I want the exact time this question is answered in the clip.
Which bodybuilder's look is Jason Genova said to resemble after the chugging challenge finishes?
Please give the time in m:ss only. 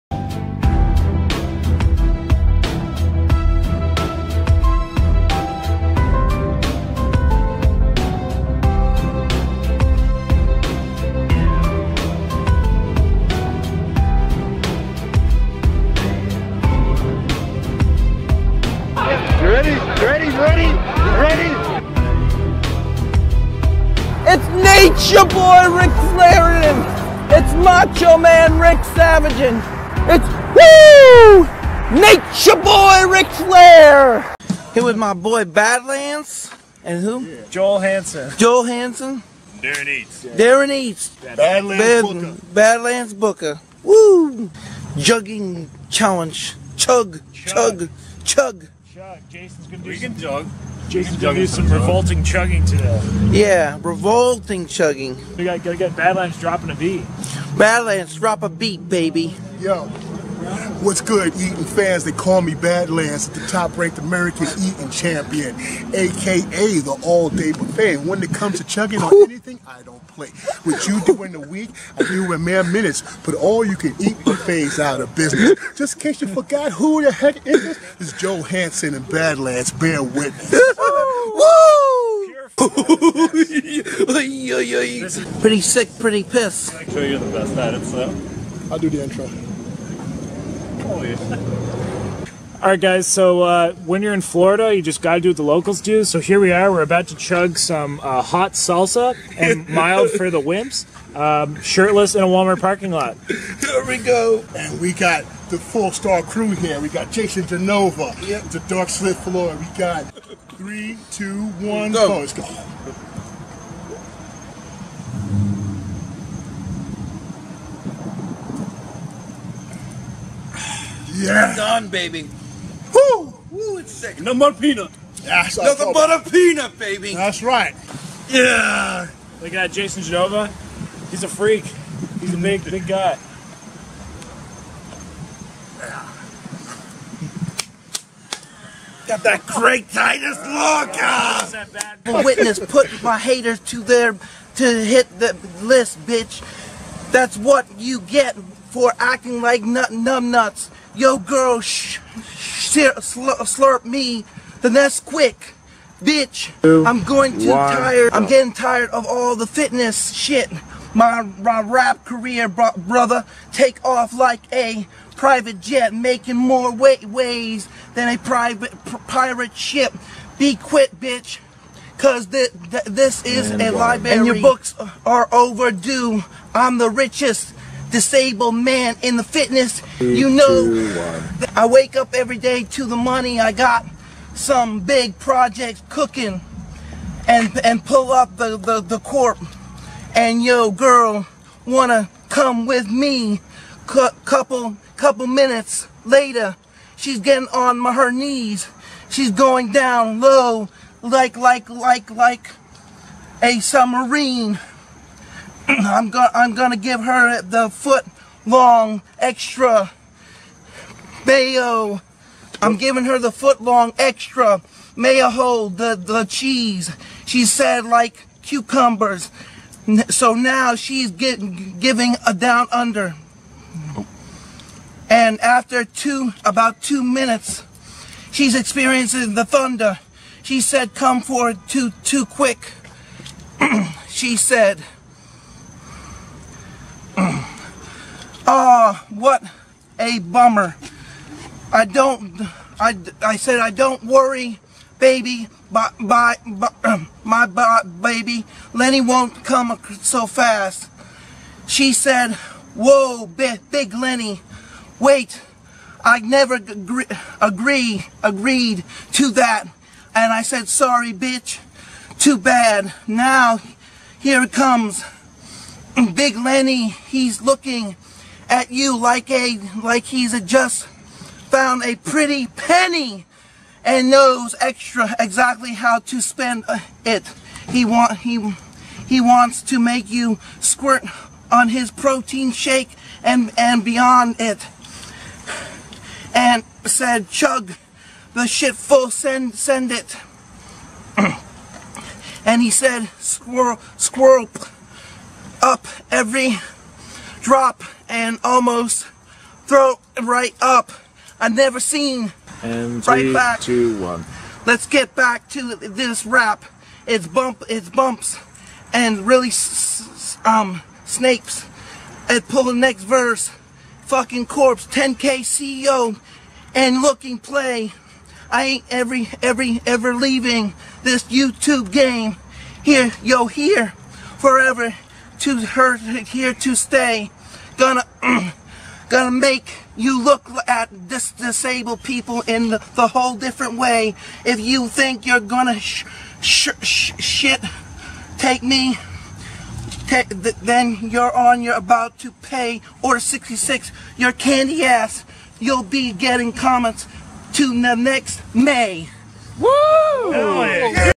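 2:19.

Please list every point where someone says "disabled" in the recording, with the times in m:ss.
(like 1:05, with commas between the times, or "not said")
2:57, 5:31.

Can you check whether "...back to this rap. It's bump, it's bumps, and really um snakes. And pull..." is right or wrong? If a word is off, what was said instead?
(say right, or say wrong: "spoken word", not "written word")
right.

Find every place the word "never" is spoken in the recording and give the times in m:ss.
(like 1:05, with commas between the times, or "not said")
4:16, 5:01.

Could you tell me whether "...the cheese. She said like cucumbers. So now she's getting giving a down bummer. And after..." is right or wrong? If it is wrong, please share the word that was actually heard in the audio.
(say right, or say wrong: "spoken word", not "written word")
wrong: "under", not "bummer".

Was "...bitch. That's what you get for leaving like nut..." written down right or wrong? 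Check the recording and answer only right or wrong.
wrong.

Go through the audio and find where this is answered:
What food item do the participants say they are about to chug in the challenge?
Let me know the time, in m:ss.
1:38.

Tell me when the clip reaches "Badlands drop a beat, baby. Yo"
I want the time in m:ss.
0:57.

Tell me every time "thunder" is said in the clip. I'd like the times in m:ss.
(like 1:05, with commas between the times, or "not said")
3:49.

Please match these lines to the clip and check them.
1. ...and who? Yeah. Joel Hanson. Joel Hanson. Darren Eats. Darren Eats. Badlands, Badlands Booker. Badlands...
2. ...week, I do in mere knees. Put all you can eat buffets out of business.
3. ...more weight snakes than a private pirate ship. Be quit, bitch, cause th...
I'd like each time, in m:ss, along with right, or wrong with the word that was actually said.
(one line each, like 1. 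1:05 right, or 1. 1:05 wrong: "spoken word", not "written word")
1. 0:36 right
2. 1:11 wrong: "minutes", not "knees"
3. 2:46 wrong: "waves", not "snakes".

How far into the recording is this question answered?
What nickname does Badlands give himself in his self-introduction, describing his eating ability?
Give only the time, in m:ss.
1:06.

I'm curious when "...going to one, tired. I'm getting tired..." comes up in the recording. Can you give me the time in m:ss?
2:37.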